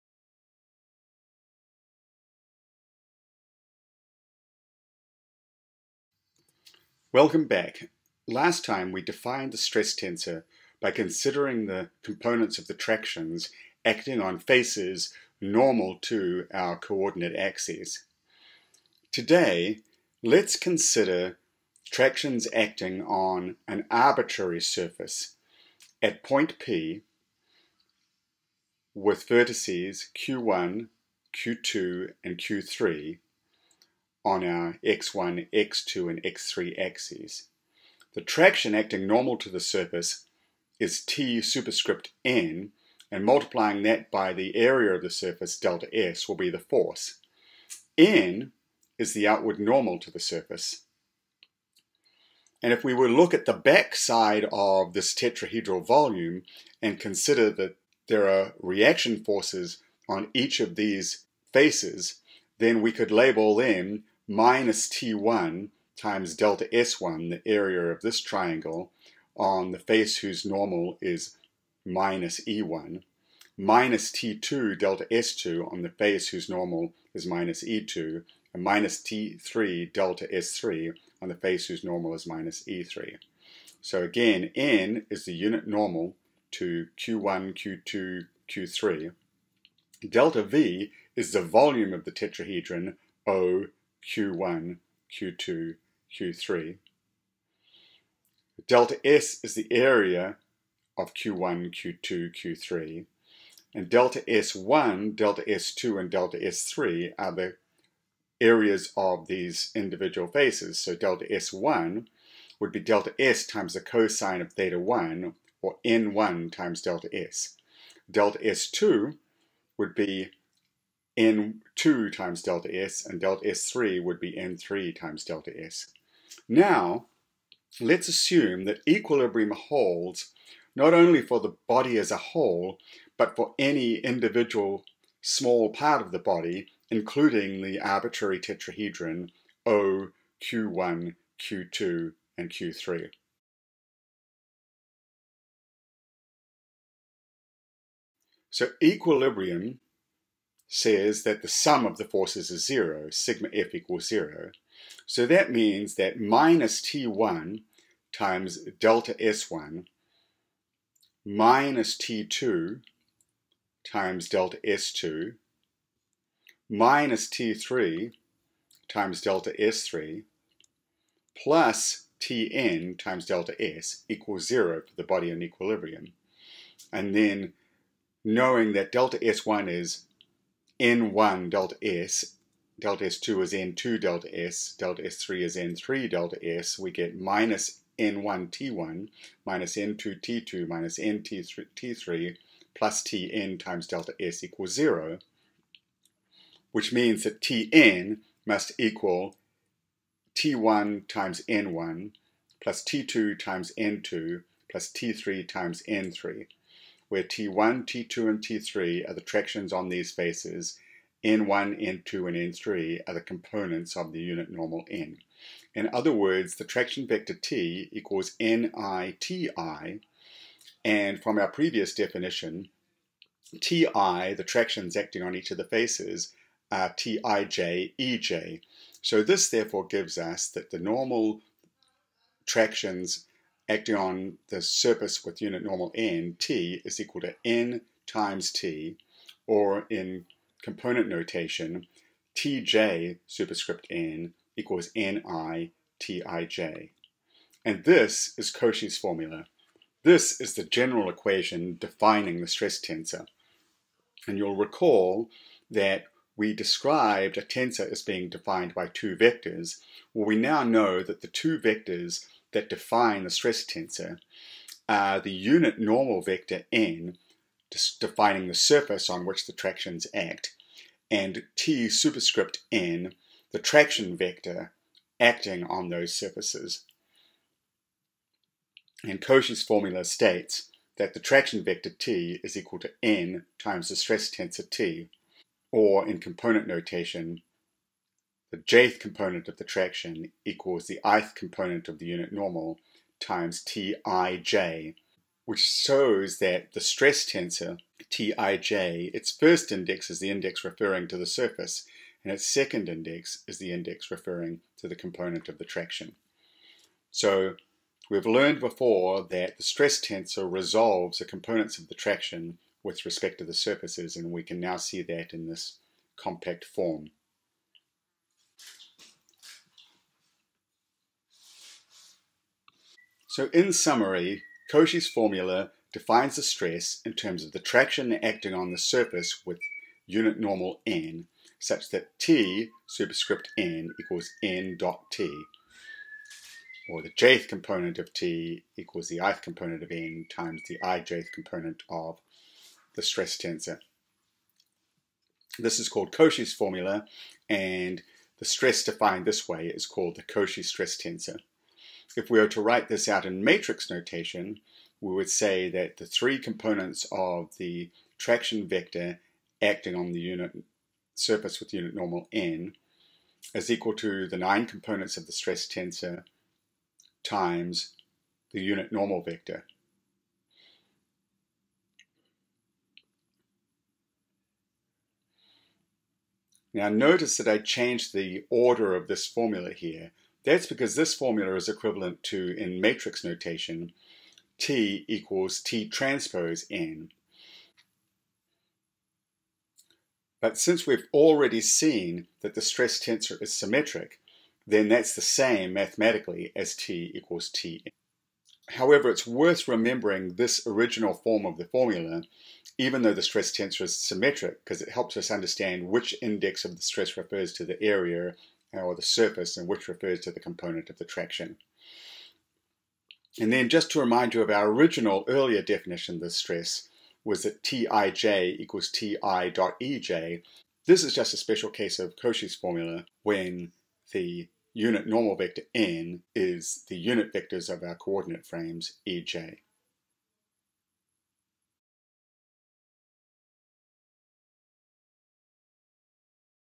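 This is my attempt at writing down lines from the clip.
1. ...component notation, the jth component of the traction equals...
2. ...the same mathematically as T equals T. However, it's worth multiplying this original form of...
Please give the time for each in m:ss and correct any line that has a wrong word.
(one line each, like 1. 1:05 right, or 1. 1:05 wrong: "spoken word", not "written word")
1. 4:46 right
2. 6:35 wrong: "remembering", not "multiplying".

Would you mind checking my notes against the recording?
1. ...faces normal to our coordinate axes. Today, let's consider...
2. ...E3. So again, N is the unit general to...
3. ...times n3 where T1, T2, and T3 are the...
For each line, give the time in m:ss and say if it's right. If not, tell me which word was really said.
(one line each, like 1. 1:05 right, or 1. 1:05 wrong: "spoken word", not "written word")
1. 0:14 right
2. 1:22 wrong: "normal", not "general"
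3. 3:25 right.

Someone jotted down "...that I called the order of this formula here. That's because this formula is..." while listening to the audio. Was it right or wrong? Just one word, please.
wrong.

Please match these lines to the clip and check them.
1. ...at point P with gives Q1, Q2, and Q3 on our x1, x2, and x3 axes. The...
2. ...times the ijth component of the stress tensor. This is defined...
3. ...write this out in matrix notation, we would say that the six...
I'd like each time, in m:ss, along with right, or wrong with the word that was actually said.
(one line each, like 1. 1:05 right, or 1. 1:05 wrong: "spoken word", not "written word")
1. 0:26 wrong: "vertices", not "gives"
2. 5:40 wrong: "called", not "defined"
3. 5:52 wrong: "three", not "six".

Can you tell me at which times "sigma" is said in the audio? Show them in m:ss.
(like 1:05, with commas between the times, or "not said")
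2:33.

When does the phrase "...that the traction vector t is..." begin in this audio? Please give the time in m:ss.
4:40.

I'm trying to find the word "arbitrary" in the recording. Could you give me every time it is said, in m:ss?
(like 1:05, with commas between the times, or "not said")
0:23, 2:17.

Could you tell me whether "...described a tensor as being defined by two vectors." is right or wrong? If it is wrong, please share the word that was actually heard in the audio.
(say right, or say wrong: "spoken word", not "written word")
right.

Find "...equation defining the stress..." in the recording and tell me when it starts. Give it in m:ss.
4:11.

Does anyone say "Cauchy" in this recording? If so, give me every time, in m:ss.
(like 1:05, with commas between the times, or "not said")
4:08, 4:39, 5:24, 5:46, 5:50, 7:02.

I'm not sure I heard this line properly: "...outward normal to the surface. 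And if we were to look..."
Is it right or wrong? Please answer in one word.
right.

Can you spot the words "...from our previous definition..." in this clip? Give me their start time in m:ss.
3:41.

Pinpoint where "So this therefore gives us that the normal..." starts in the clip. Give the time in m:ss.
3:49.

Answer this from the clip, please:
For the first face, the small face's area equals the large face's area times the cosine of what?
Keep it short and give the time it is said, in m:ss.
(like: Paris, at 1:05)
theta 1, at 1:54.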